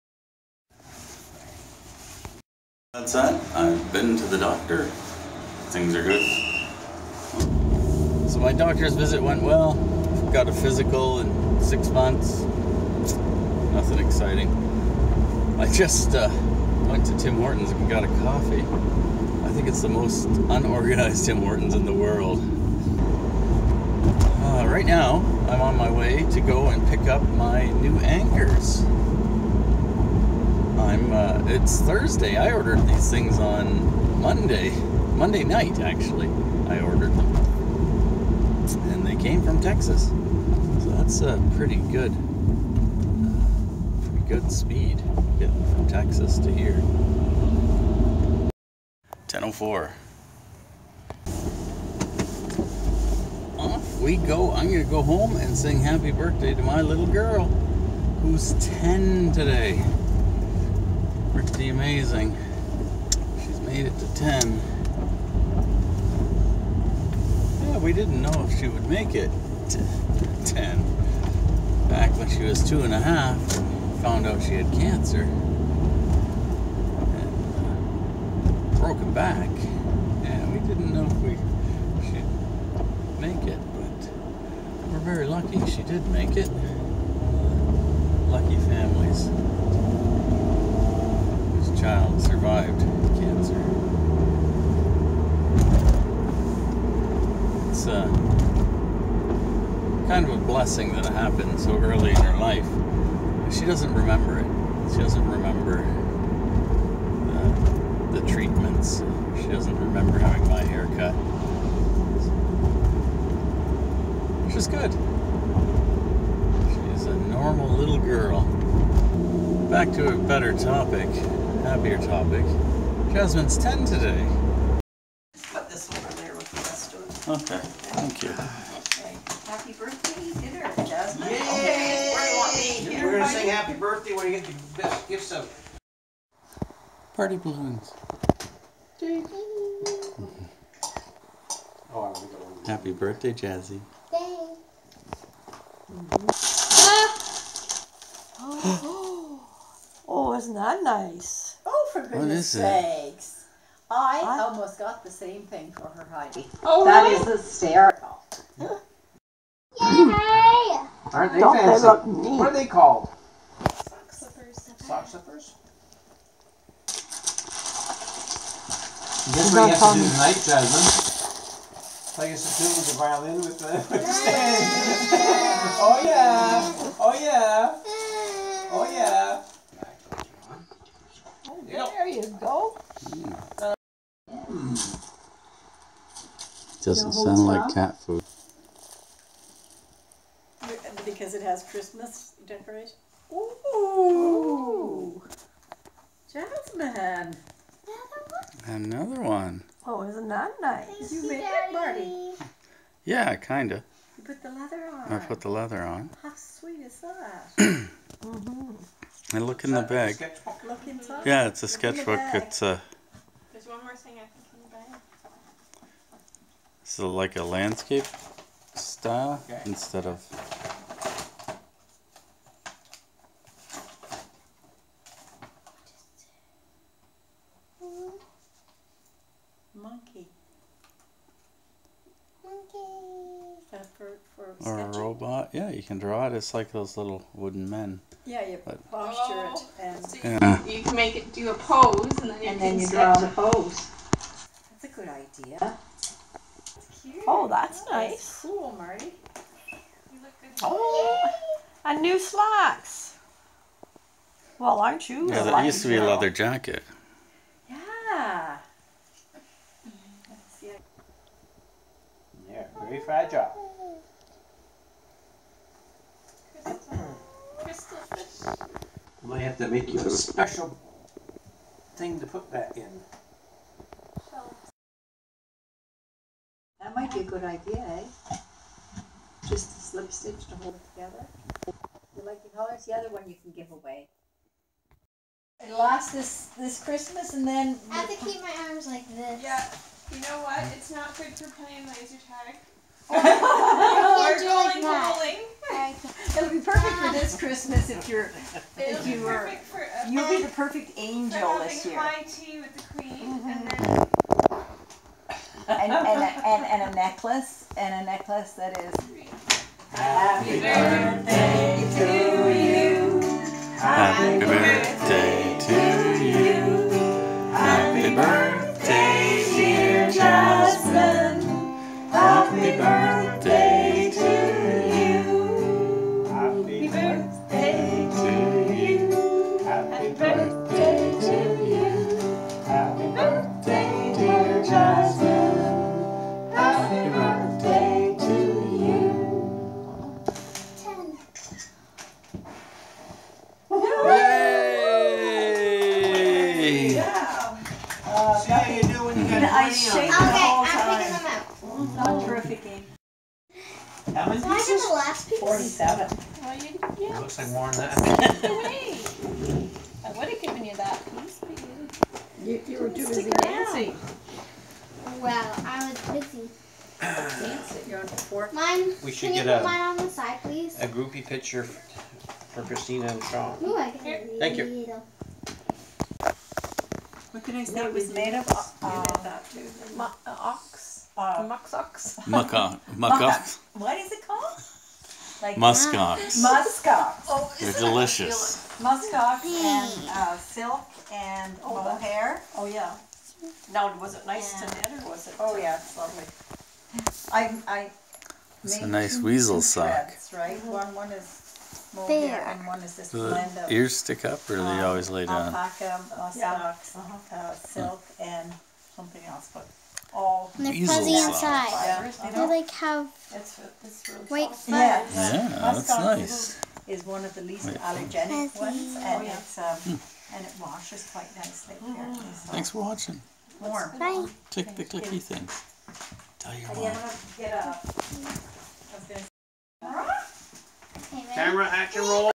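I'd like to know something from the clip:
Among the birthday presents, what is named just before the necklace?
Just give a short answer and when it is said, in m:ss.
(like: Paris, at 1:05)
High tea with the queen, at 5:01.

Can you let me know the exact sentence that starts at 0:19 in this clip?
I think it's the most unorganized Tim Hortons in the world.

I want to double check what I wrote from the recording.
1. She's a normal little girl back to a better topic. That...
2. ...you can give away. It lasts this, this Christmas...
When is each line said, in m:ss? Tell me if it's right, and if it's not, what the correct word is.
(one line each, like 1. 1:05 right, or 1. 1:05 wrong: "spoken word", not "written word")
1. 1:56 right
2. 4:43 right.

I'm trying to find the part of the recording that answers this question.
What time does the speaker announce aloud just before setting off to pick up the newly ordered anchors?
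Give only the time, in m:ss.
0:49.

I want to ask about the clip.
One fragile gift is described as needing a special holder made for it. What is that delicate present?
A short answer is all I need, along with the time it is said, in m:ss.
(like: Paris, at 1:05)
Crystal fish, at 4:27.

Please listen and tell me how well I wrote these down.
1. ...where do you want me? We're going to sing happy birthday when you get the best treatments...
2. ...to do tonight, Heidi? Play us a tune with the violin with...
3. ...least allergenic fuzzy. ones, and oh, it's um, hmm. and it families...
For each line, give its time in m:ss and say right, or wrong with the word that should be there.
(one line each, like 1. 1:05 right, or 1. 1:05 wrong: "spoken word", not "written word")
1. 2:12 wrong: "gifts", not "treatments"
2. 2:49 wrong: "Jasmine", not "Heidi"
3. 6:57 wrong: "washes", not "families".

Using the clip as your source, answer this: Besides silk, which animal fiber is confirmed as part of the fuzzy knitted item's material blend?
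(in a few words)
alpaca.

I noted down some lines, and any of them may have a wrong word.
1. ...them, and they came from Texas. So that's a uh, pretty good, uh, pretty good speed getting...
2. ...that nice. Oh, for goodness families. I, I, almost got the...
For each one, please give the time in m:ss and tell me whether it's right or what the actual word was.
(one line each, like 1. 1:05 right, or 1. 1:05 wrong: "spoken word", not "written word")
1. 0:37 right
2. 2:30 wrong: "sakes", not "families".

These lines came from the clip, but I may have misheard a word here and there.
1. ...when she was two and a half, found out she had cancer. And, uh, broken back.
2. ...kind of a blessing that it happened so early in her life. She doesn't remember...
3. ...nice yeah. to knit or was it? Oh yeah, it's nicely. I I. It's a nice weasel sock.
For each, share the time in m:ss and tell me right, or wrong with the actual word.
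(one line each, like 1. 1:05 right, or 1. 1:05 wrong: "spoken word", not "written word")
1. 1:12 right
2. 1:40 right
3. 6:34 wrong: "lovely", not "nicely".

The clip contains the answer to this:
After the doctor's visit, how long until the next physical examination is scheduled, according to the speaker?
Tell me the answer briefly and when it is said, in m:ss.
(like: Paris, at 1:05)
six months, at 0:11.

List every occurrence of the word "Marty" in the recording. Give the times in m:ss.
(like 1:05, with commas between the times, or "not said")
3:21, 4:08.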